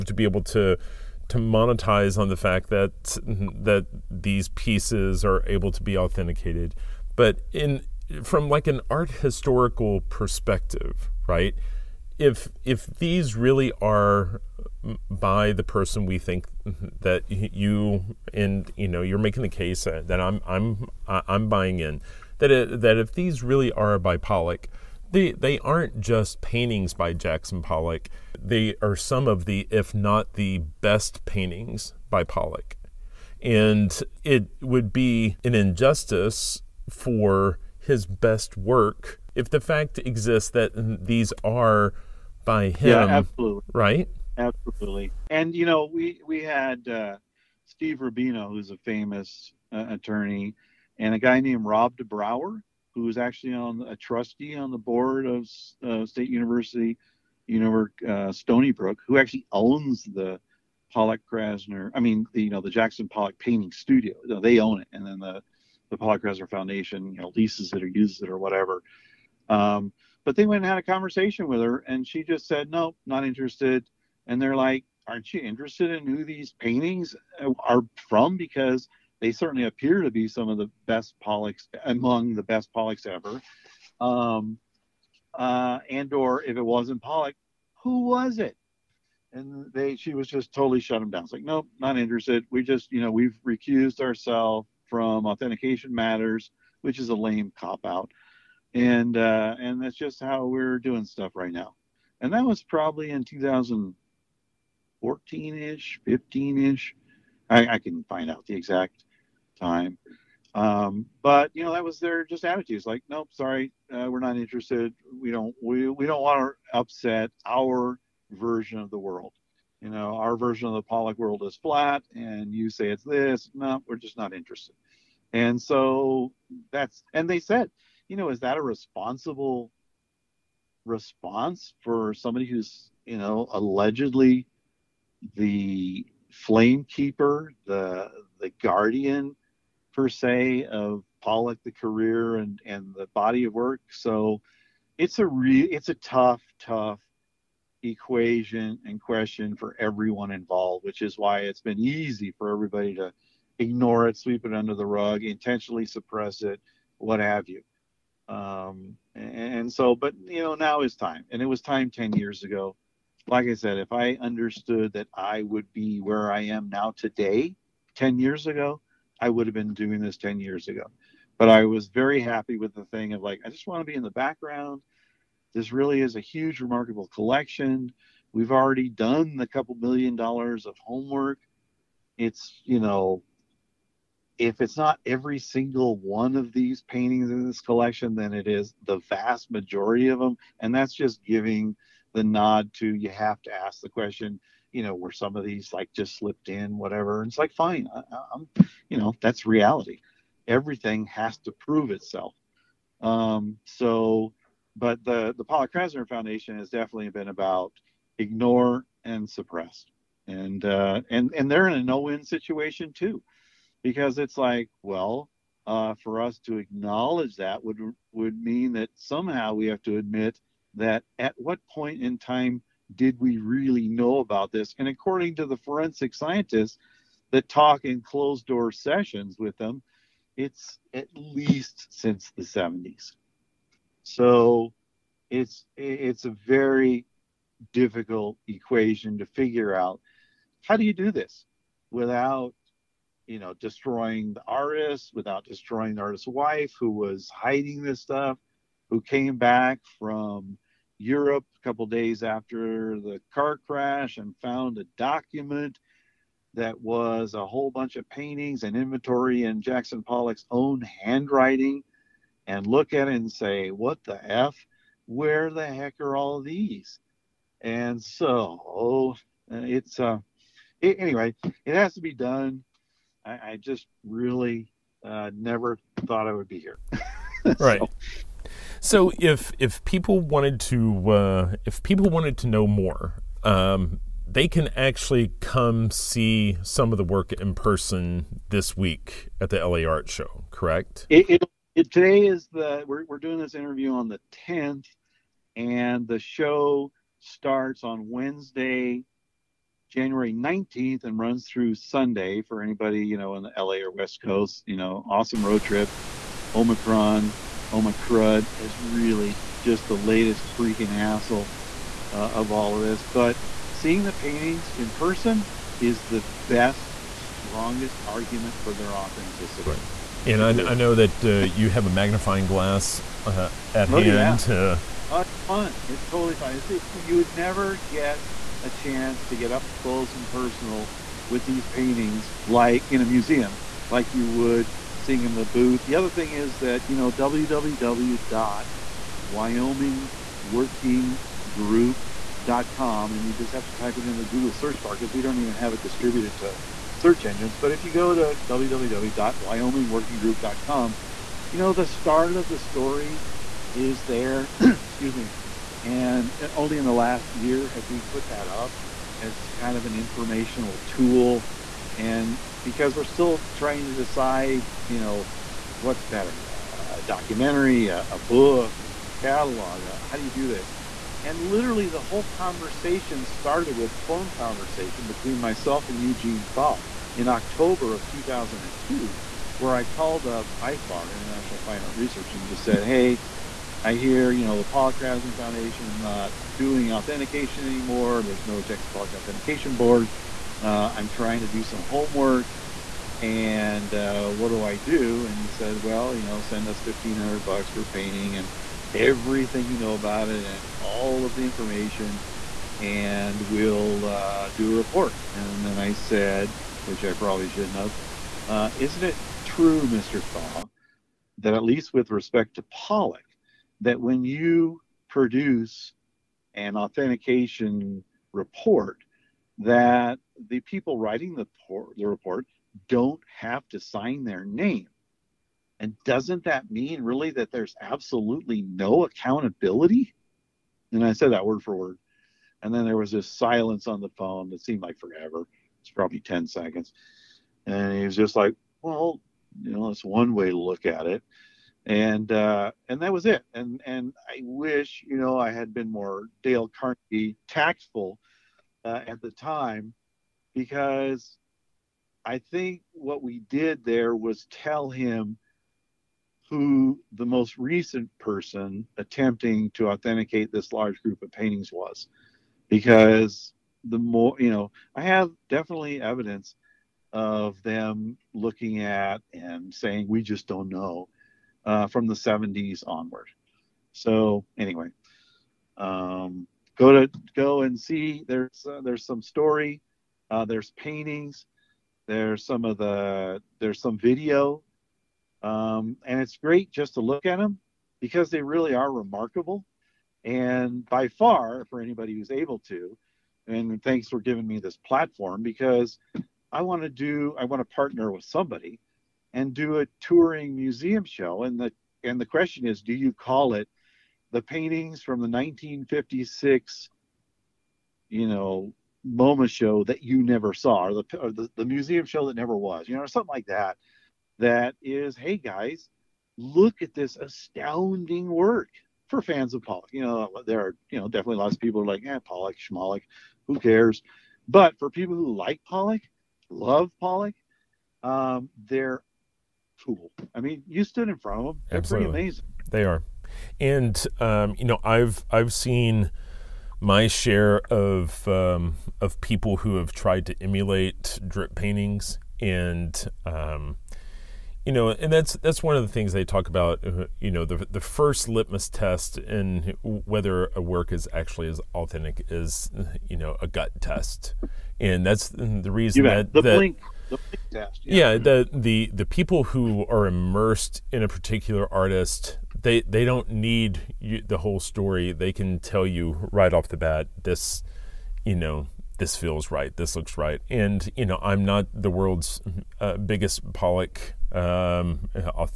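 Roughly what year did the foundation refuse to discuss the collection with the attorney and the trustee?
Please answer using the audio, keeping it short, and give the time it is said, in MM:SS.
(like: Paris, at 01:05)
2014, at 01:43.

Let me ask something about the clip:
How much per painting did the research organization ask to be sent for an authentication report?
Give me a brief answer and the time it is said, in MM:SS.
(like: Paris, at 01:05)
$1500, at 06:36.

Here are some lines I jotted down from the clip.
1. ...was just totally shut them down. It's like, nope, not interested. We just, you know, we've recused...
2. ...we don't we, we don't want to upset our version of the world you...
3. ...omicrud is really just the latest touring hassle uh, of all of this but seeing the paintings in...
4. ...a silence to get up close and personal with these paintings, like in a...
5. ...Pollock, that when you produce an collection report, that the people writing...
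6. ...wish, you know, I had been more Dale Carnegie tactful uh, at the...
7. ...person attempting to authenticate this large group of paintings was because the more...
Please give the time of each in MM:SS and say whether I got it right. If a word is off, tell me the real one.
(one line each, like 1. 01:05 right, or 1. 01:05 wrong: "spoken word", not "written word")
1. 01:30 right
2. 01:55 right
3. 05:07 wrong: "freaking", not "touring"
4. 05:28 wrong: "chance", not "silence"
5. 06:52 wrong: "authentication", not "collection"
6. 07:24 right
7. 07:38 right.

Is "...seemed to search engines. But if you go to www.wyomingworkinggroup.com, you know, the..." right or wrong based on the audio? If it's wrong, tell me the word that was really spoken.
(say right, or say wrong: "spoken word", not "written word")
wrong: "distributed", not "seemed".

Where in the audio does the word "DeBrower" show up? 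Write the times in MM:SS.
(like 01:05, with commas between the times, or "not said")
00:51.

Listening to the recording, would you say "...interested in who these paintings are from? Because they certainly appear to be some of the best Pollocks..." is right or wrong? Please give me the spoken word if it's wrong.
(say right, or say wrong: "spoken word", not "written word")
right.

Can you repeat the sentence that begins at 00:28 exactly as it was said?
They are some of the if not the best paintings by Pollock.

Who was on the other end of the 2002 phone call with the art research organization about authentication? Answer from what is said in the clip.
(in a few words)
Eugene Thaw.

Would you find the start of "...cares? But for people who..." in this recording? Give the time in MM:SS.
08:43.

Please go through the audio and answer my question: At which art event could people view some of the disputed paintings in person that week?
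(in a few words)
LA Art Show.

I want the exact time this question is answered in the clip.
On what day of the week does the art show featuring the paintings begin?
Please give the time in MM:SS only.
04:58.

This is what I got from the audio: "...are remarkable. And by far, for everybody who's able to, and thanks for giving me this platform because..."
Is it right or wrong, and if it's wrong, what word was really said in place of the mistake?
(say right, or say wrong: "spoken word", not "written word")
wrong: "anybody", not "everybody".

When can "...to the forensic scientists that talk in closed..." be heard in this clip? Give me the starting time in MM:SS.
03:45.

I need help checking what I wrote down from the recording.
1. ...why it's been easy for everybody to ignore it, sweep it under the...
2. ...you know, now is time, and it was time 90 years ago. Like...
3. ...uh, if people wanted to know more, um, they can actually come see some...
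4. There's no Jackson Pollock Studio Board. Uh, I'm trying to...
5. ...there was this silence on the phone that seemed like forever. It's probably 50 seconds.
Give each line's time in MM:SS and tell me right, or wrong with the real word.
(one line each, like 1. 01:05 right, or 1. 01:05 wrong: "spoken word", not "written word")
1. 02:31 right
2. 02:40 wrong: "10", not "90"
3. 04:41 right
4. 06:28 wrong: "Authentication", not "Studio"
5. 07:12 wrong: "10", not "50".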